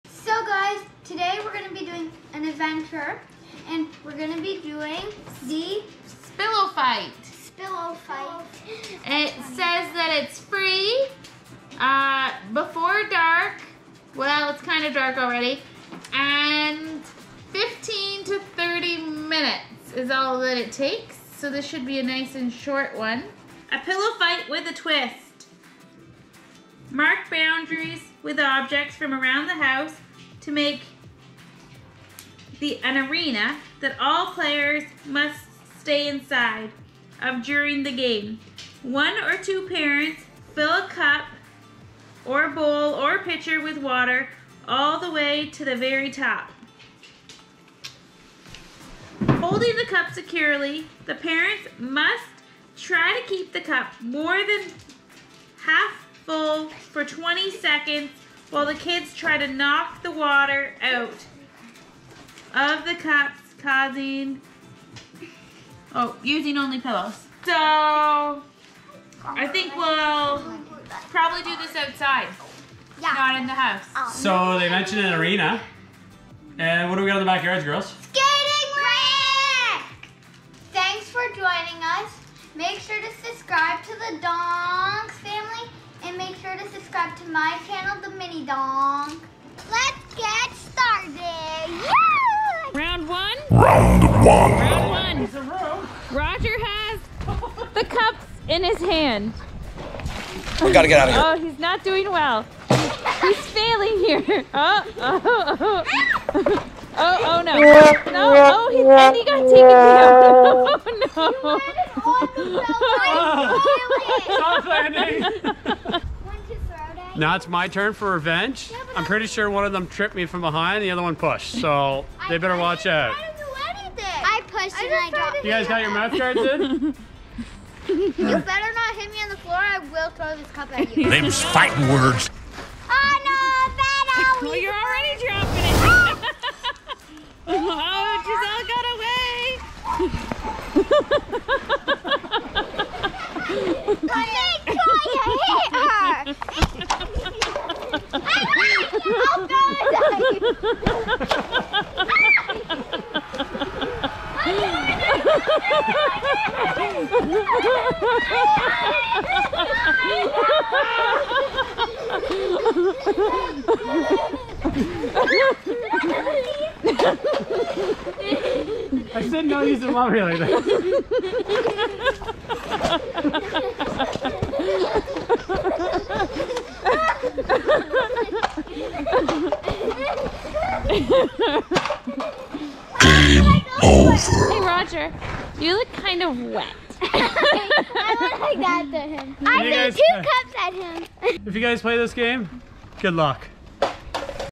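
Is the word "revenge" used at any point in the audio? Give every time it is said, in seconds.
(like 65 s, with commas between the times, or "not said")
118 s.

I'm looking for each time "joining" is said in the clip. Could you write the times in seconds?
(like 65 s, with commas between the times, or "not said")
81 s.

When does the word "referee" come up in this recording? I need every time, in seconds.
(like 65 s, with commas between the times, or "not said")
not said.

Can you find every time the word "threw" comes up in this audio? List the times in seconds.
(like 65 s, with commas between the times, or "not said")
189 s.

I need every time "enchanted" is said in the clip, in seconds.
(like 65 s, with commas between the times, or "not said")
not said.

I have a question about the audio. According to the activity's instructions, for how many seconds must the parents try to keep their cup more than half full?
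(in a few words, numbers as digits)
20 seconds.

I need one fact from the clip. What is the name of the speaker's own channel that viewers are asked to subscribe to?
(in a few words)
The Mini Donk.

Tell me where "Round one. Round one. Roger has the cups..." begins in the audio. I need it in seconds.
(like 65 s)
93 s.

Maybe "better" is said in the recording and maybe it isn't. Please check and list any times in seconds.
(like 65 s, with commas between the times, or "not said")
122 s, 128 s.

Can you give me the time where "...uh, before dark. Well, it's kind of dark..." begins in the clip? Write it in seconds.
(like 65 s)
11 s.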